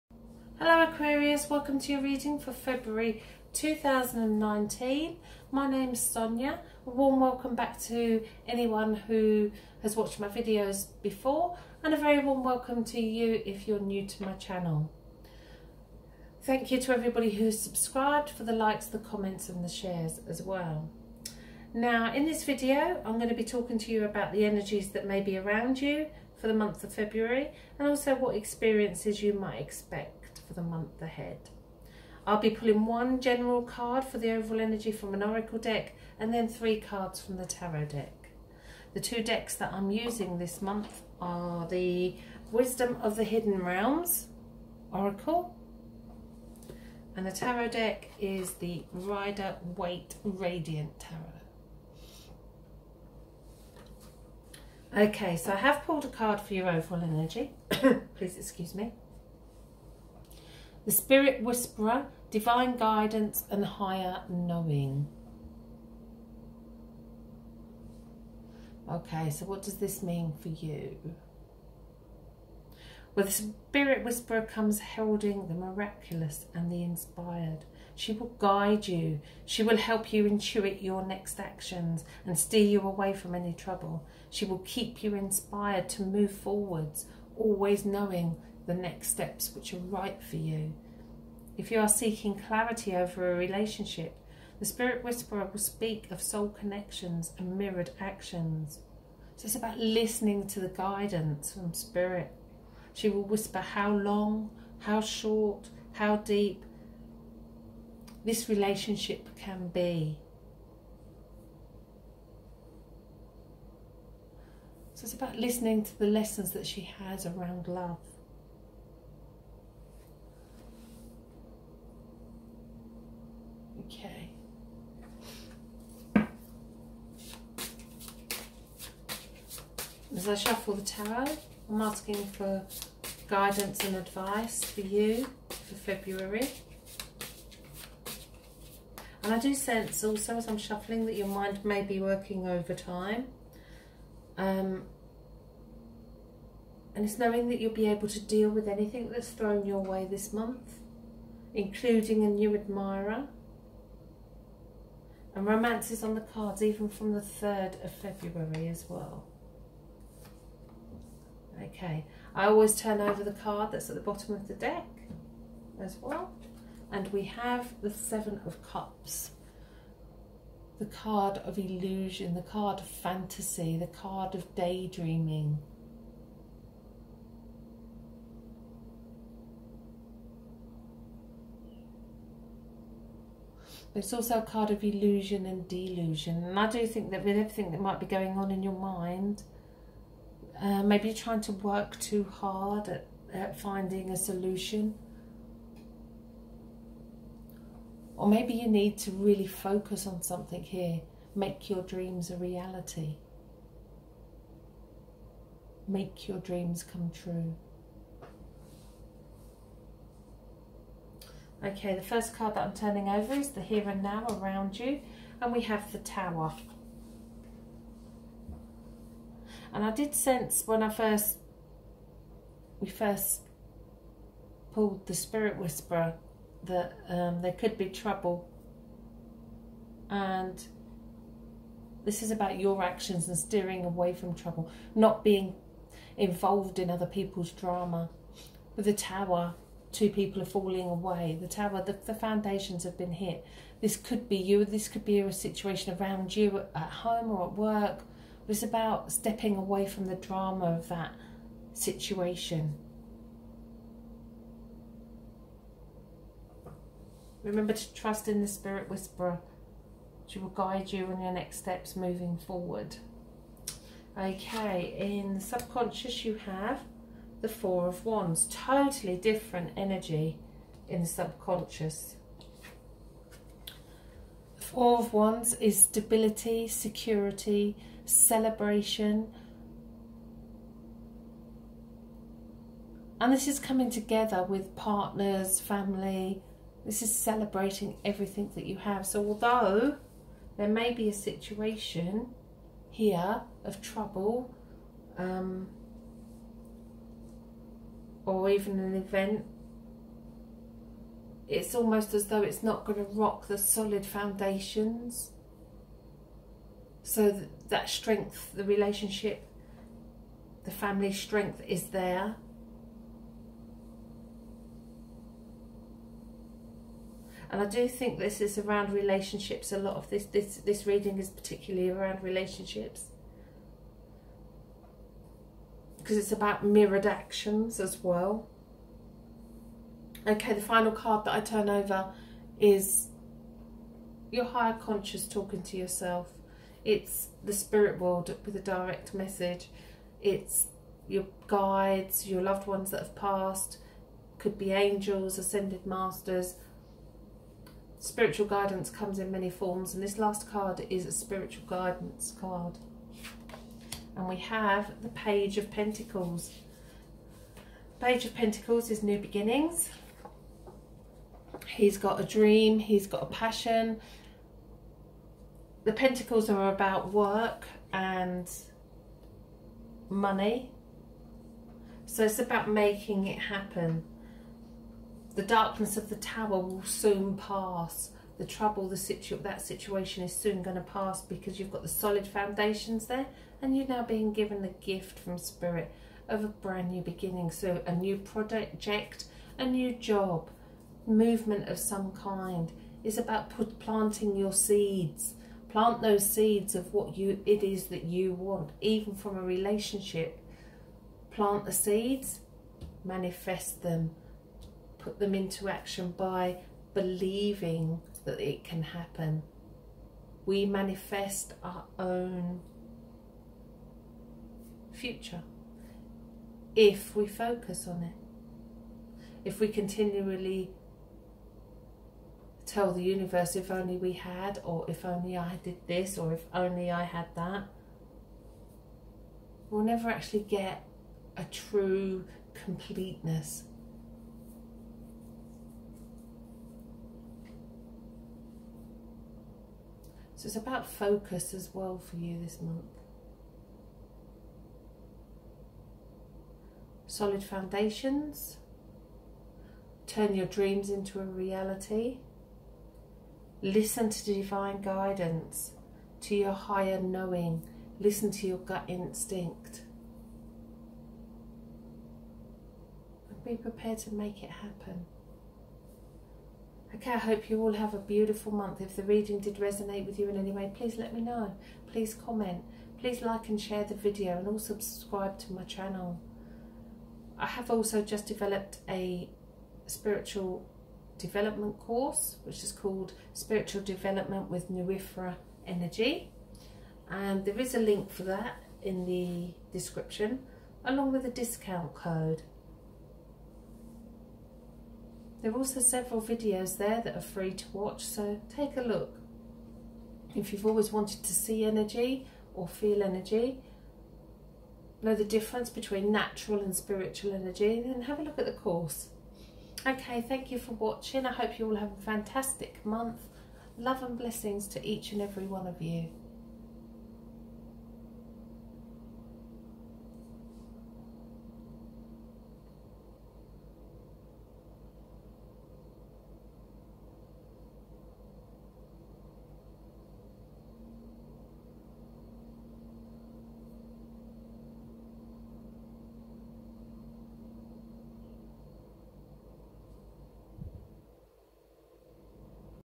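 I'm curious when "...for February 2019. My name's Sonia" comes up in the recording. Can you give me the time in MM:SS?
00:02.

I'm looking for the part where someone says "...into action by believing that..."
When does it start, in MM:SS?
06:45.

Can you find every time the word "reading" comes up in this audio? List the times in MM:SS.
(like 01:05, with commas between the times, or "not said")
00:02, 05:20, 07:49.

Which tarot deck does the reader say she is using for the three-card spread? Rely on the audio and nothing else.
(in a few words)
Rider Waite Radiant Tarot.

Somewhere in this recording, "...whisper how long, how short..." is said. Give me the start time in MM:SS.
01:43.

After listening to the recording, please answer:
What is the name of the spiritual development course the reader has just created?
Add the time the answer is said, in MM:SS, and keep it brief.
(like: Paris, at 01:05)
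Spiritual Development with Bnwyfre Energy, at 08:03.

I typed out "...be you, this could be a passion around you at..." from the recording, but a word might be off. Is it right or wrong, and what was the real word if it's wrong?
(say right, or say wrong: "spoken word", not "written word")
wrong: "situation", not "passion".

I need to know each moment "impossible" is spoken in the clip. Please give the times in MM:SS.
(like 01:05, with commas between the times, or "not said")
not said.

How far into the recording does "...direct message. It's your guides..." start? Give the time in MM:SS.
05:38.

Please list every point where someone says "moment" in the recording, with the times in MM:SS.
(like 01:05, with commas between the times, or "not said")
not said.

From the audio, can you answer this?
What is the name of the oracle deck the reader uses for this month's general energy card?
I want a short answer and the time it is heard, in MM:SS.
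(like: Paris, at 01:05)
Wisdom of the Hidden Realms Oracle, at 00:42.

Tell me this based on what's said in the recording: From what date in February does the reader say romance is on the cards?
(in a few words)
3rd of February.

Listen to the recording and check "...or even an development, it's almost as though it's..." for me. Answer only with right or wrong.
wrong.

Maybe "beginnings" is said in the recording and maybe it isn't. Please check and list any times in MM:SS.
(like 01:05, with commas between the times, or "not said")
05:59, 06:27.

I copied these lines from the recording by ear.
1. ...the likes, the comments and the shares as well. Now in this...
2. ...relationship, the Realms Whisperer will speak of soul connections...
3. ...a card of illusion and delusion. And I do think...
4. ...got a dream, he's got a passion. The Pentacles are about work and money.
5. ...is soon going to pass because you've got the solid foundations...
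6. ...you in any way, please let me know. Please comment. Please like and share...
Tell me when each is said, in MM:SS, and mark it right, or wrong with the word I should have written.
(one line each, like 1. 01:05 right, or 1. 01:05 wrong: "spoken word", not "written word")
1. 00:18 right
2. 01:33 wrong: "Spirit", not "Realms"
3. 03:04 right
4. 06:01 right
5. 06:20 right
6. 07:50 right.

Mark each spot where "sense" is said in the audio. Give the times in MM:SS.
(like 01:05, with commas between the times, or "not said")
02:19, 03:40.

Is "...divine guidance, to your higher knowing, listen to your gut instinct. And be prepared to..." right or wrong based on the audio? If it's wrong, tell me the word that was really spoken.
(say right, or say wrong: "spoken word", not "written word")
right.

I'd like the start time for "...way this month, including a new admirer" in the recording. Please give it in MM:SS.
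02:29.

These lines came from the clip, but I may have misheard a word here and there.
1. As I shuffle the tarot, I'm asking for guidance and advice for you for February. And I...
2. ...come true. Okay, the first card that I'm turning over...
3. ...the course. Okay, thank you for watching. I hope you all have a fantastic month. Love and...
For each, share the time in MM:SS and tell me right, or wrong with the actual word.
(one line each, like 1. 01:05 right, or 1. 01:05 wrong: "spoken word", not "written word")
1. 02:10 right
2. 03:26 right
3. 08:28 right.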